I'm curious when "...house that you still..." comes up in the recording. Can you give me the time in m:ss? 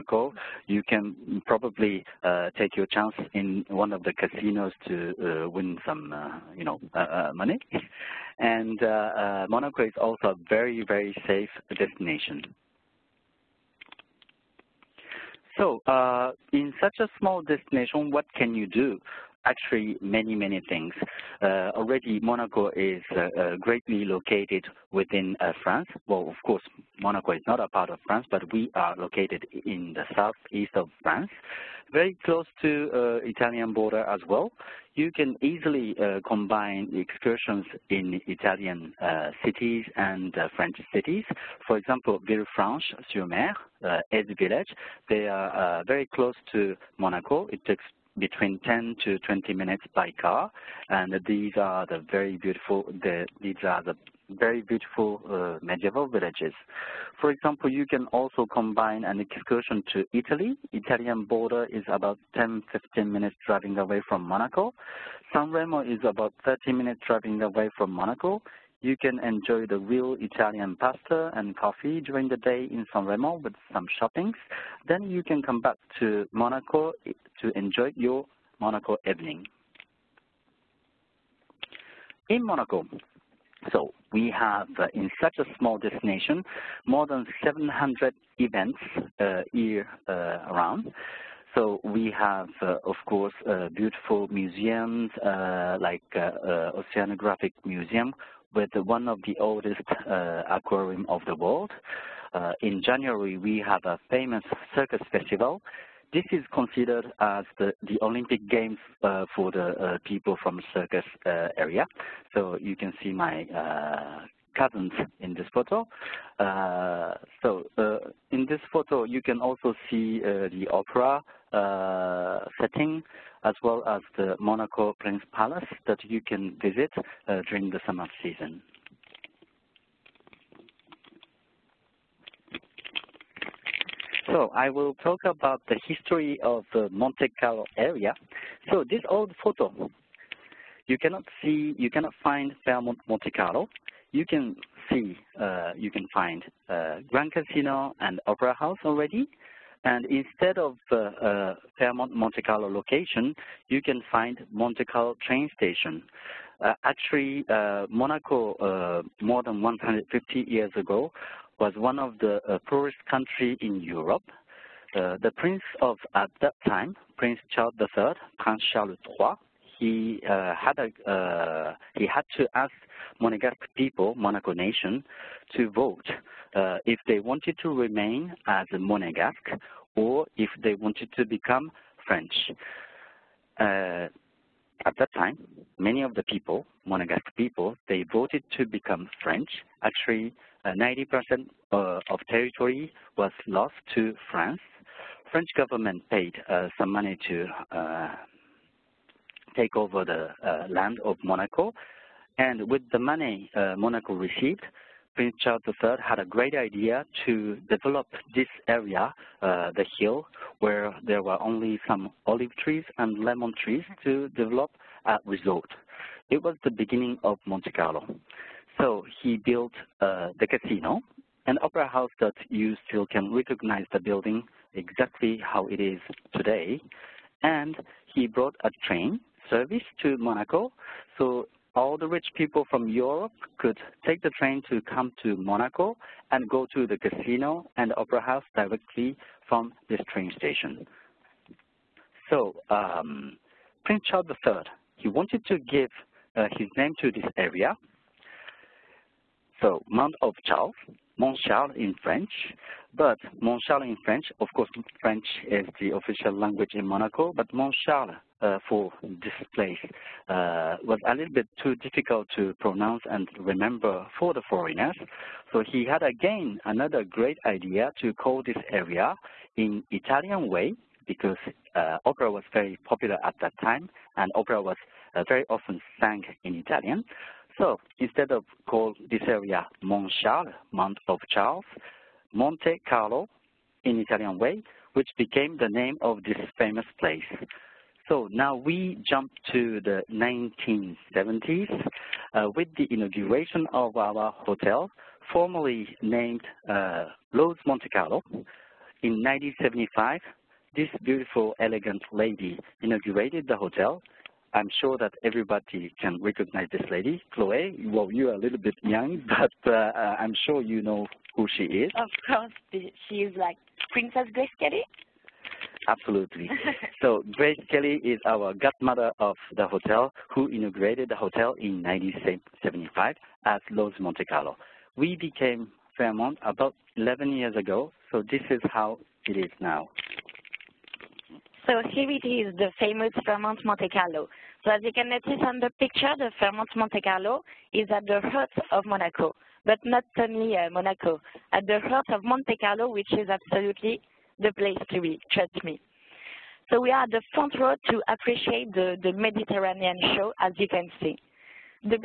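3:41.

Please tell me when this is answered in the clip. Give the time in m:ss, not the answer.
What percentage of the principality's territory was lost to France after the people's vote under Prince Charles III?
3:10.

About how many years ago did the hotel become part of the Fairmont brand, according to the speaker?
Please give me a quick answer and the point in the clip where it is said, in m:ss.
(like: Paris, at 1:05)
11 years, at 5:26.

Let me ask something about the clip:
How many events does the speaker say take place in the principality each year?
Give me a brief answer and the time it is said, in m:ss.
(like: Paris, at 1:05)
more than 700, at 1:26.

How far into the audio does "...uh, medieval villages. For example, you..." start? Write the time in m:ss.
0:55.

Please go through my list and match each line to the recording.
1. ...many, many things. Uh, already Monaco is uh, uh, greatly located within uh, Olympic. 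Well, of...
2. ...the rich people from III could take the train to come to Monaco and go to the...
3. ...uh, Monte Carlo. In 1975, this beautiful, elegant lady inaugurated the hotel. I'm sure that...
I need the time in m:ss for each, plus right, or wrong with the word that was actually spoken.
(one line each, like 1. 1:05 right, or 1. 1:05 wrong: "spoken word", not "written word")
1. 0:20 wrong: "France", not "Olympic"
2. 3:51 wrong: "Europe", not "III"
3. 4:56 right.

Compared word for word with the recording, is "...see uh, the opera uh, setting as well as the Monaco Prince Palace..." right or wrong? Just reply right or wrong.
right.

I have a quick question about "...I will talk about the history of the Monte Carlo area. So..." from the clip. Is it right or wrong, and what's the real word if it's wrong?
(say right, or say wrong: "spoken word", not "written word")
right.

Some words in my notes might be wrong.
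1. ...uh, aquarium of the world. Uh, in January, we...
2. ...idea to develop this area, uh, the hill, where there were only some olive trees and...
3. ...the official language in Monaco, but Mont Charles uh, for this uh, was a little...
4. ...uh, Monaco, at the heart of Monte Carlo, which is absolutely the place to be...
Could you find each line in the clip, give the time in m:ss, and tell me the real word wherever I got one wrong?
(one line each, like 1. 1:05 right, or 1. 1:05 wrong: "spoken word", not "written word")
1. 1:40 right
2. 3:26 right
3. 4:15 right
4. 5:40 right.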